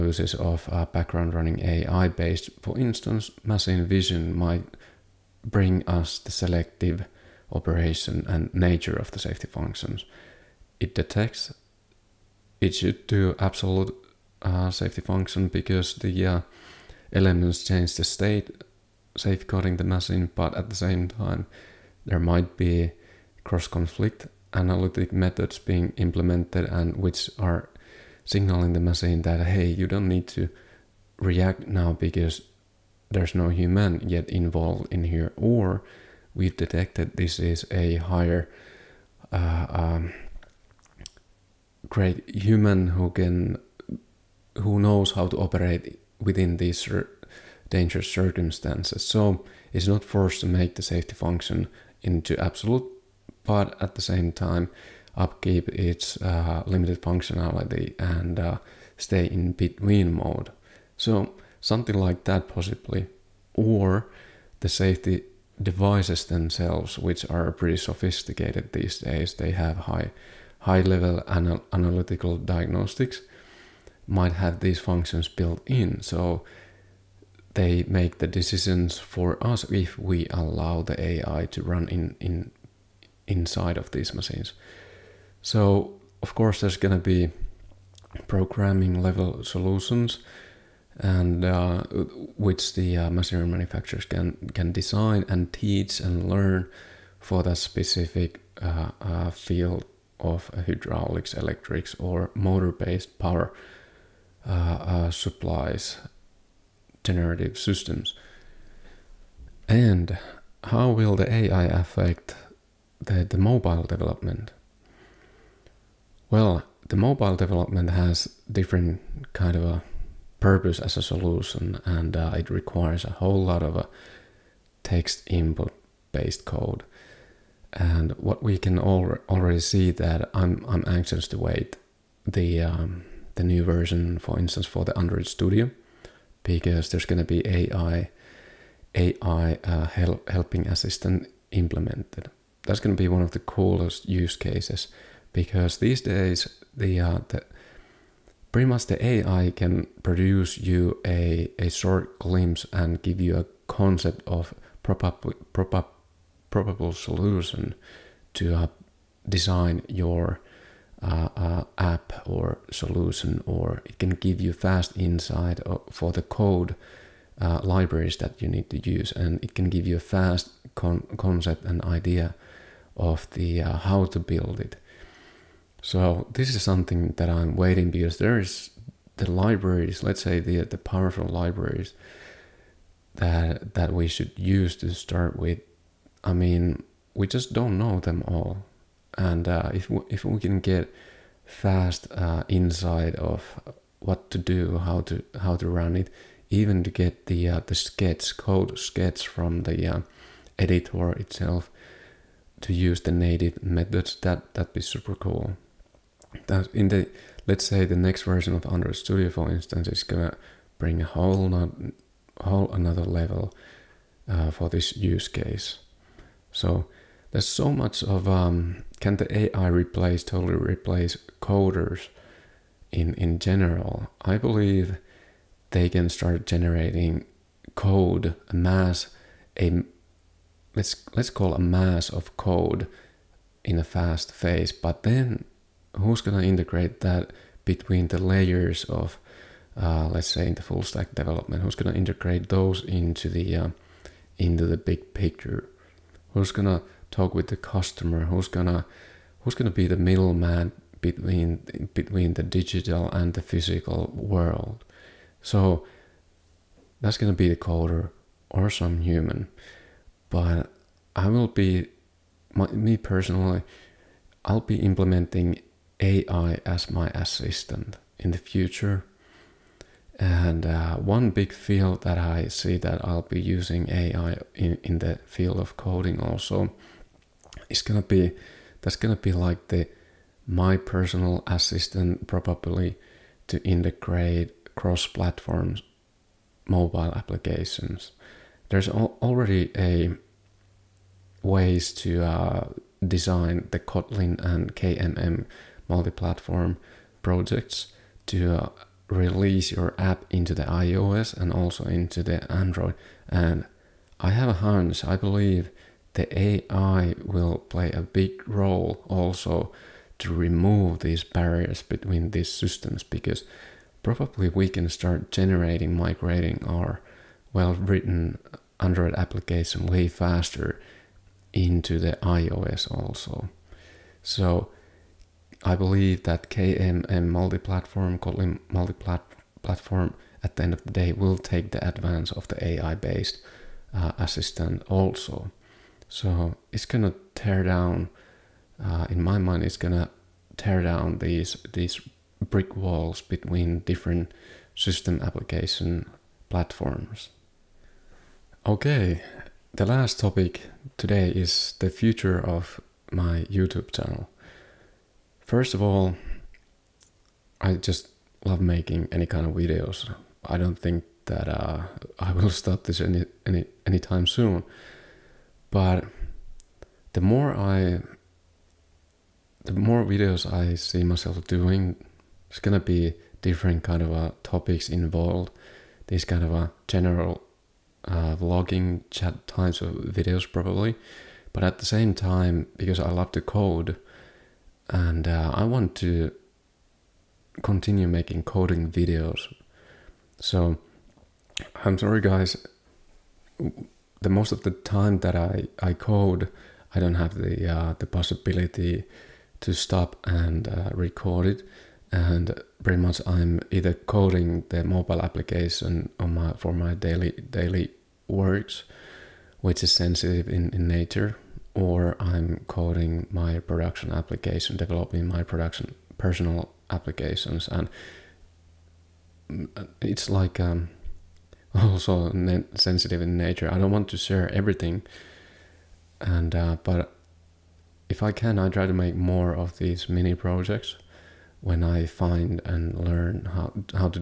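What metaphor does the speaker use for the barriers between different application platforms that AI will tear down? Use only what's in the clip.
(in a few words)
Brick walls.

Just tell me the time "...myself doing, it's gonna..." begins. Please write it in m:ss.
6:11.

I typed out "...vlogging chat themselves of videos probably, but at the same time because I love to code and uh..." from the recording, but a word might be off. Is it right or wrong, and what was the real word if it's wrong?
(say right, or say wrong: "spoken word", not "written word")
wrong: "types", not "themselves".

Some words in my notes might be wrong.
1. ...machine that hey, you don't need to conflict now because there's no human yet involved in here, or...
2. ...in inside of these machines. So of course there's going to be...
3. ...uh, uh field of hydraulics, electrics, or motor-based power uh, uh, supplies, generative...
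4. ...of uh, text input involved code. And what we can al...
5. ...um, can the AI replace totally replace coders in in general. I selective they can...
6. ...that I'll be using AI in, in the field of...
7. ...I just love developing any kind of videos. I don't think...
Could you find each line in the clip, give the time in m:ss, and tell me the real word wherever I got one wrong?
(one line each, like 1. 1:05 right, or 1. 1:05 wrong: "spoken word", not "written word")
1. 0:28 wrong: "react", not "conflict"
2. 1:22 right
3. 1:38 right
4. 2:03 wrong: "based", not "involved"
5. 3:38 wrong: "believe", not "selective"
6. 4:32 right
7. 5:57 wrong: "making", not "developing".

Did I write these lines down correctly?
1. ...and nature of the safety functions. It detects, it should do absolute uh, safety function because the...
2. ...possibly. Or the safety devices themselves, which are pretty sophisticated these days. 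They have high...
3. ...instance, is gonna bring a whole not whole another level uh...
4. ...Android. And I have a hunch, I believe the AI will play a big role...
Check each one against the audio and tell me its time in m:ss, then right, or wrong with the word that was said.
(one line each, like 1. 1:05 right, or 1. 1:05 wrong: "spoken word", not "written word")
1. 0:08 right
2. 1:02 right
3. 3:29 right
4. 5:02 right.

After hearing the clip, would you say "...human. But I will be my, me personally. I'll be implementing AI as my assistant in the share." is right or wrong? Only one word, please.
wrong.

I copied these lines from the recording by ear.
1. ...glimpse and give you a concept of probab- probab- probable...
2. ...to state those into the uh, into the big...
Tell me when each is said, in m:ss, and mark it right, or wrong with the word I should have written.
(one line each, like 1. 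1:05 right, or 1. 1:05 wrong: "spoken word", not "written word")
1. 2:32 right
2. 4:01 wrong: "integrate", not "state".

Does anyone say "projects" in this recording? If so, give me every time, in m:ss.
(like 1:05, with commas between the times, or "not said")
4:57, 7:10.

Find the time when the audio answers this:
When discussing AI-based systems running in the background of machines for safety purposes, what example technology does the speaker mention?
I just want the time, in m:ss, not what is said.
0:03.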